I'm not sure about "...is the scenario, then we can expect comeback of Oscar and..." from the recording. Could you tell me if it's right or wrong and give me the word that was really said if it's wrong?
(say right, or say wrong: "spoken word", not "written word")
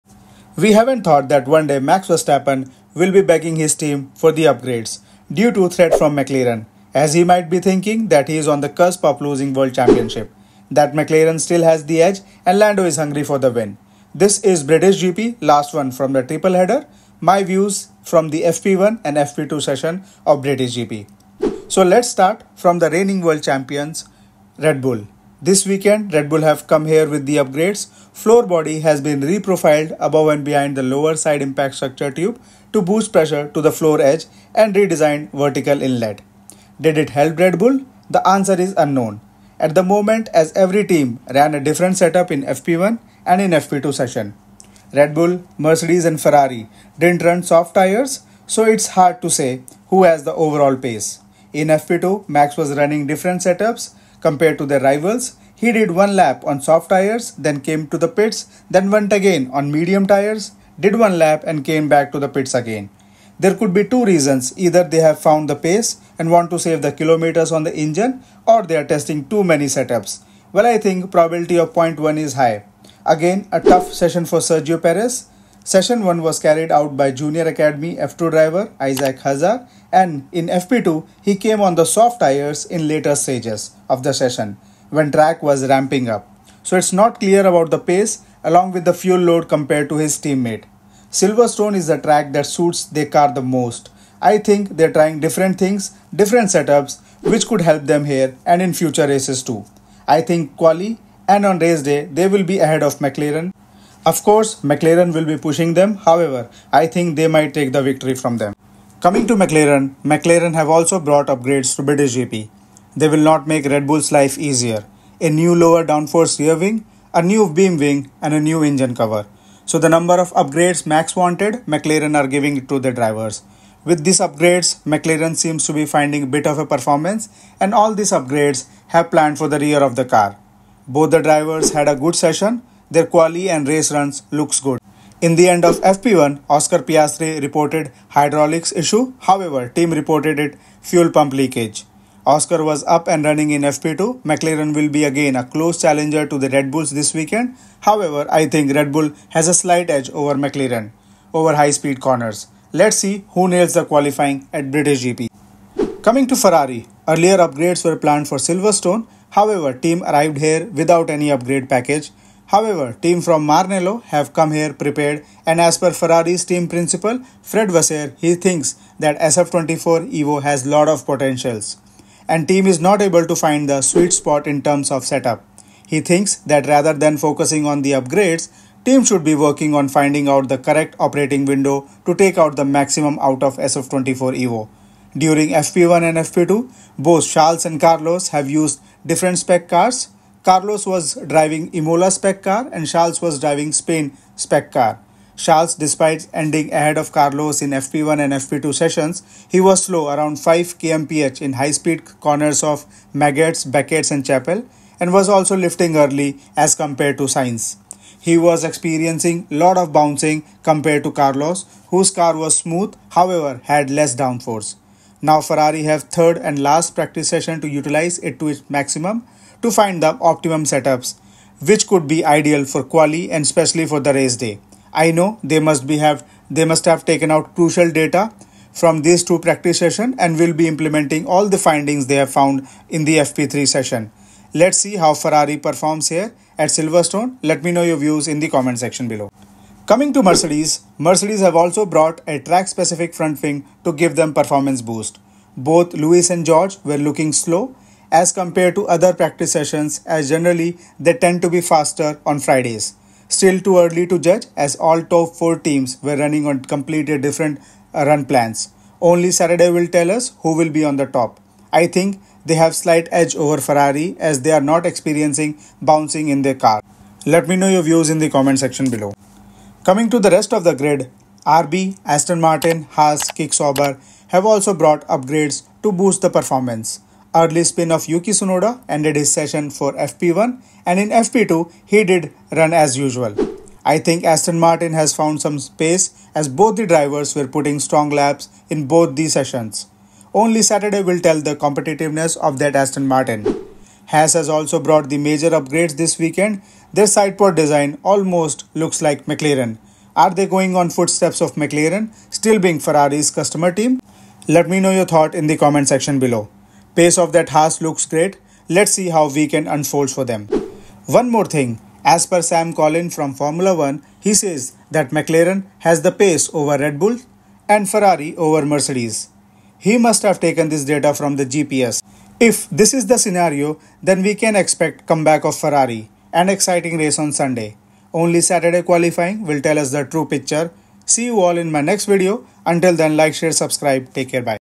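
wrong: "Ferrari", not "Oscar".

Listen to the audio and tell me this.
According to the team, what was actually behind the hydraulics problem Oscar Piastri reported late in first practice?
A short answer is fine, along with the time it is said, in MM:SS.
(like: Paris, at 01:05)
Fuel pump leakage, at 02:20.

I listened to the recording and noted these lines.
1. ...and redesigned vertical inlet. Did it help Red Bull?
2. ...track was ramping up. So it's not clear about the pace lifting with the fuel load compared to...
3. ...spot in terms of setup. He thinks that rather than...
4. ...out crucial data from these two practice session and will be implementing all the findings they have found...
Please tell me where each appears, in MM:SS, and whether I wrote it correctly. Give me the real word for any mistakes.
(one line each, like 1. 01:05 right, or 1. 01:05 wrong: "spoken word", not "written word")
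1. 00:34 right
2. 01:25 wrong: "along", not "lifting"
3. 02:54 right
4. 03:47 right.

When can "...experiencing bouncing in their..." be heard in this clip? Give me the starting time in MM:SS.
04:24.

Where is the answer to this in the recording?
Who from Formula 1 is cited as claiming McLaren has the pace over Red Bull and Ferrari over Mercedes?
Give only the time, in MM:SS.
05:12.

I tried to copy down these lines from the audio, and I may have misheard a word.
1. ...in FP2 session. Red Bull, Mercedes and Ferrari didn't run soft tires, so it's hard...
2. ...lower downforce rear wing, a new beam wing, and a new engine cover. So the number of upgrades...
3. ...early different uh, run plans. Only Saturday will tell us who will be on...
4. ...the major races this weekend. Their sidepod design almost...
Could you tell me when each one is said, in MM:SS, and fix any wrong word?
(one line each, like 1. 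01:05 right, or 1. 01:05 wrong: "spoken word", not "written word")
1. 00:43 right
2. 01:55 right
3. 04:16 wrong: "completely", not "early"
4. 04:55 wrong: "upgrades", not "races".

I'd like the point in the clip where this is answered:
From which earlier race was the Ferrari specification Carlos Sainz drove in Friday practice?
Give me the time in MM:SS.
03:11.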